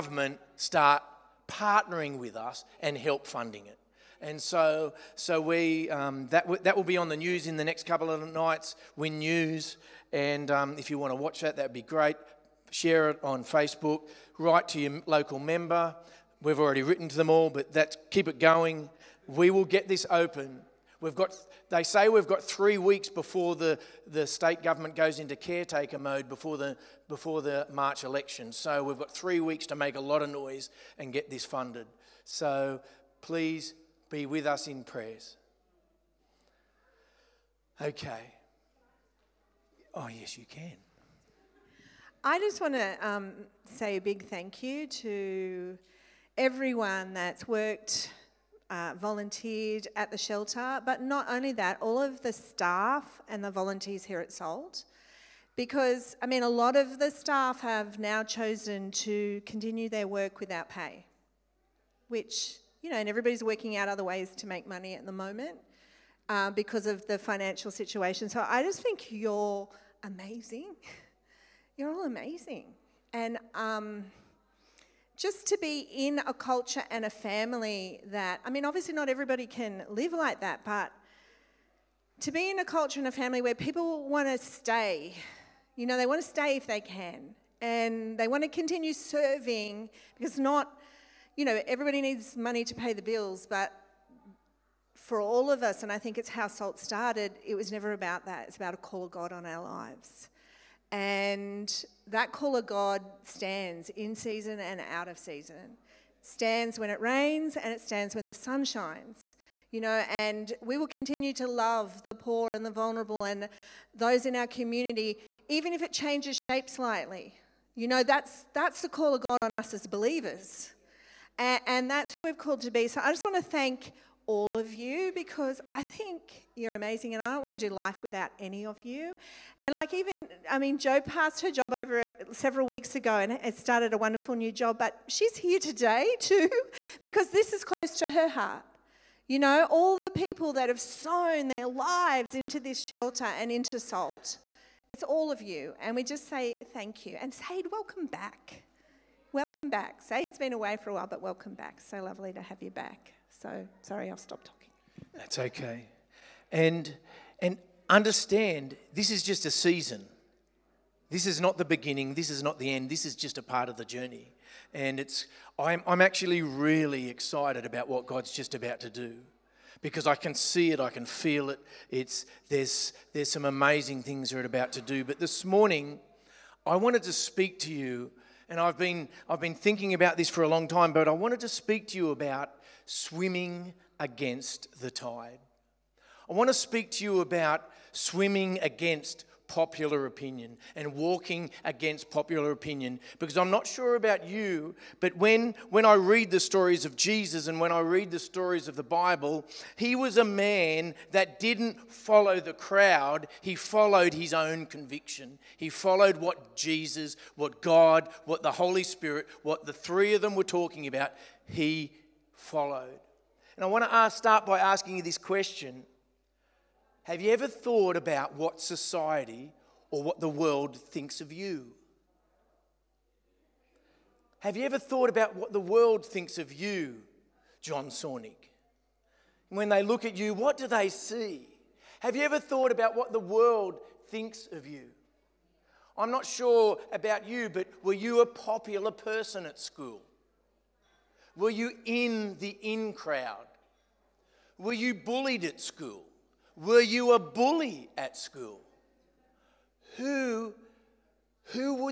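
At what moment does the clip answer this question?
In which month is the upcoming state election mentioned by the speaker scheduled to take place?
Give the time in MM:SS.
00:27.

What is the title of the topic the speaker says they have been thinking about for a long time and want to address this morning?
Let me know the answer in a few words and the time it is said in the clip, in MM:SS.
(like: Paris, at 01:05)
Swimming against the tide, at 03:02.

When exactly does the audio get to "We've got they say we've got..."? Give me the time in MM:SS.
00:21.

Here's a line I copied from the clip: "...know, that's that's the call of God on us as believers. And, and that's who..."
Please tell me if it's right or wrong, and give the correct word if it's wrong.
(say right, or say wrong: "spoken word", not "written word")
right.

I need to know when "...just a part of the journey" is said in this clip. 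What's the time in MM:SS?
02:43.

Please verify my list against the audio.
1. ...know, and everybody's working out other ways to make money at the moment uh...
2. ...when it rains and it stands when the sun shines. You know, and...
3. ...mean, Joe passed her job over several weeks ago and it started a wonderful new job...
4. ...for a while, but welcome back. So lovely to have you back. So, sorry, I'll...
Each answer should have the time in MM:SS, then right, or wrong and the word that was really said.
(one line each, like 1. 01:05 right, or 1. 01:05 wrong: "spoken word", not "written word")
1. 01:02 right
2. 01:46 right
3. 02:10 right
4. 02:30 right.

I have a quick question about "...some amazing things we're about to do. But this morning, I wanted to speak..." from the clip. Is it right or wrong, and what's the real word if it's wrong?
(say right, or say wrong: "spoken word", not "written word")
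right.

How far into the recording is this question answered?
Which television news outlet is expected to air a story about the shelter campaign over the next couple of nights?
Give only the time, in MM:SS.
00:08.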